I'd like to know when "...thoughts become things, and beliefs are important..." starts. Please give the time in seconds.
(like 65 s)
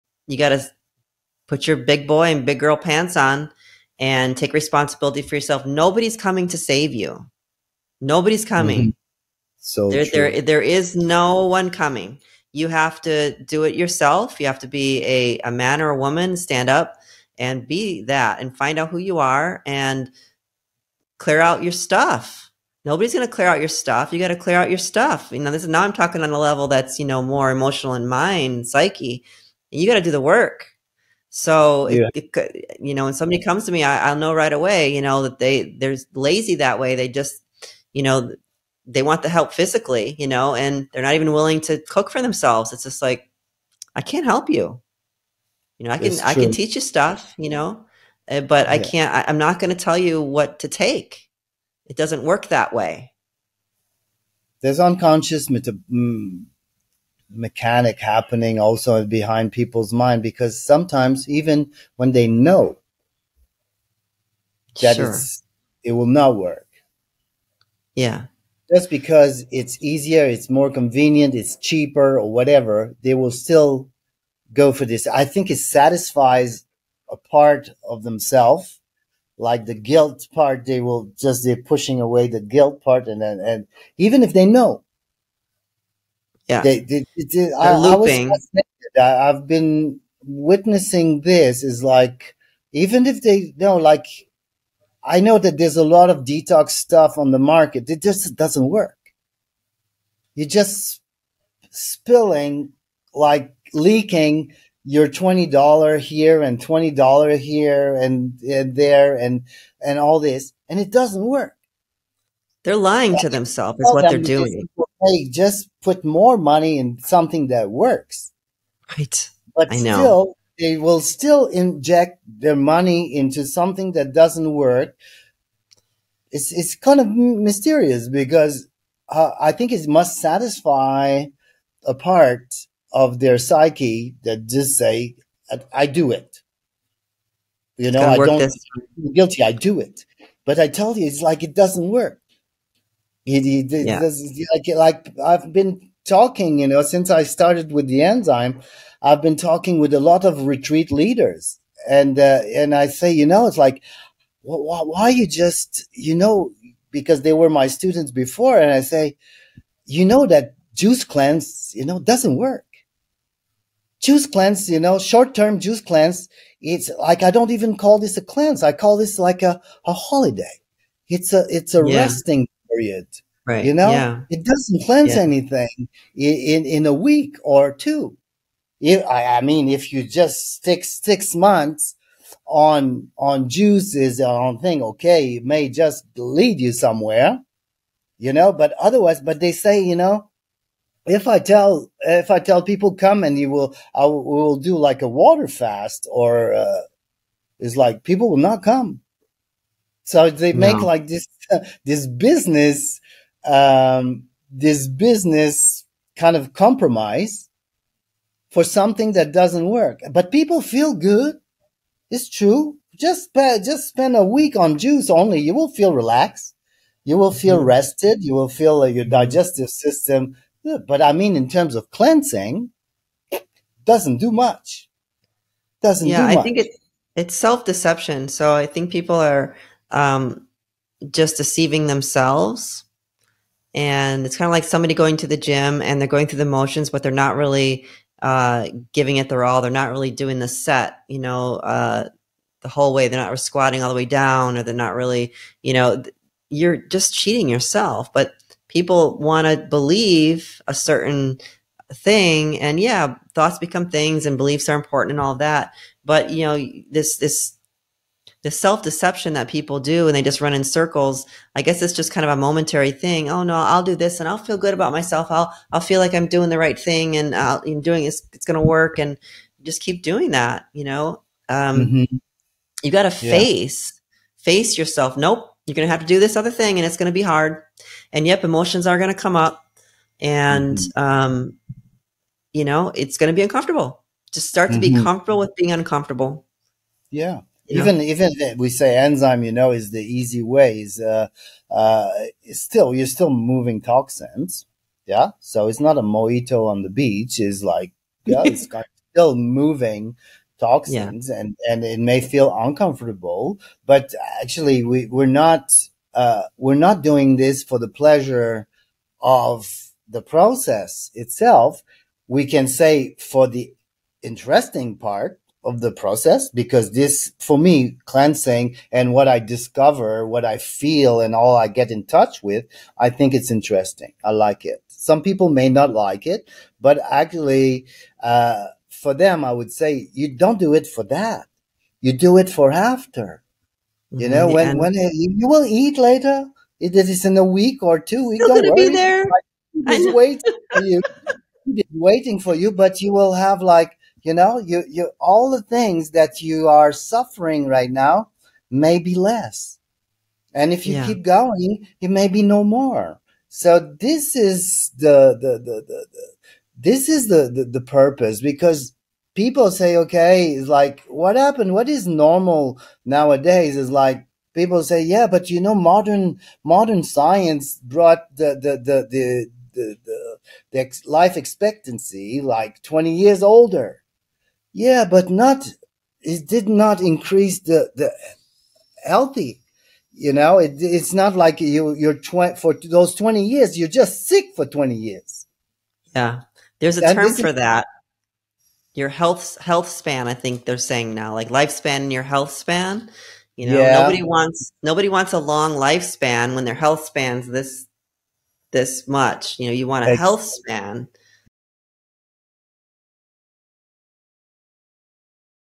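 253 s.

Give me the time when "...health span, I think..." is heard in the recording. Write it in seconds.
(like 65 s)
389 s.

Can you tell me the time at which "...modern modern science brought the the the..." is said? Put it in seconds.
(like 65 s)
365 s.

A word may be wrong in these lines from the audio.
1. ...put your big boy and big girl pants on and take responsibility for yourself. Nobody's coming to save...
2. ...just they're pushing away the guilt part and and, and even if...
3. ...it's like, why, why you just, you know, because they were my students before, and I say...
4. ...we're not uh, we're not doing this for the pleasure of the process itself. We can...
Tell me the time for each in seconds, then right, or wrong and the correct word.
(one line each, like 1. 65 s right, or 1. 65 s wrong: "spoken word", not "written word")
1. 1 s right
2. 81 s right
3. 153 s right
4. 305 s right.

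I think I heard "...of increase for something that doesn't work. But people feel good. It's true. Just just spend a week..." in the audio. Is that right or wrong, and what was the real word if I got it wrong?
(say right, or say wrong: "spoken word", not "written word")
wrong: "compromise", not "increase".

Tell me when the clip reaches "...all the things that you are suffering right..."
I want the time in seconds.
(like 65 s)
345 s.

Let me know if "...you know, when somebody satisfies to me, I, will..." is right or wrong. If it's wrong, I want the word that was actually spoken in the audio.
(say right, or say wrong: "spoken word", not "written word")
wrong: "comes", not "satisfies".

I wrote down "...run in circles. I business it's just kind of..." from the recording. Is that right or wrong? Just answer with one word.
wrong.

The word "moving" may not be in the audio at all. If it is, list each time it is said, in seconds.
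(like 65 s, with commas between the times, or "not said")
293 s, 299 s.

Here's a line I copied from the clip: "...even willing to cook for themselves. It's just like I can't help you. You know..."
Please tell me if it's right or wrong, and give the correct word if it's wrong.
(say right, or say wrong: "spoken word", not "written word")
right.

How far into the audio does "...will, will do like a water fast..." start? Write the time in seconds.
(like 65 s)
194 s.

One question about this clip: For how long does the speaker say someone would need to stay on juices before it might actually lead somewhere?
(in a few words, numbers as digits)
6 months.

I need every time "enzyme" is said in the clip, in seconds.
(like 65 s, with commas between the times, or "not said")
148 s, 288 s.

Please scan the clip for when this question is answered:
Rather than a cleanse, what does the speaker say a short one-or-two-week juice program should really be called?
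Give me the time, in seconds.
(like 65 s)
169 s.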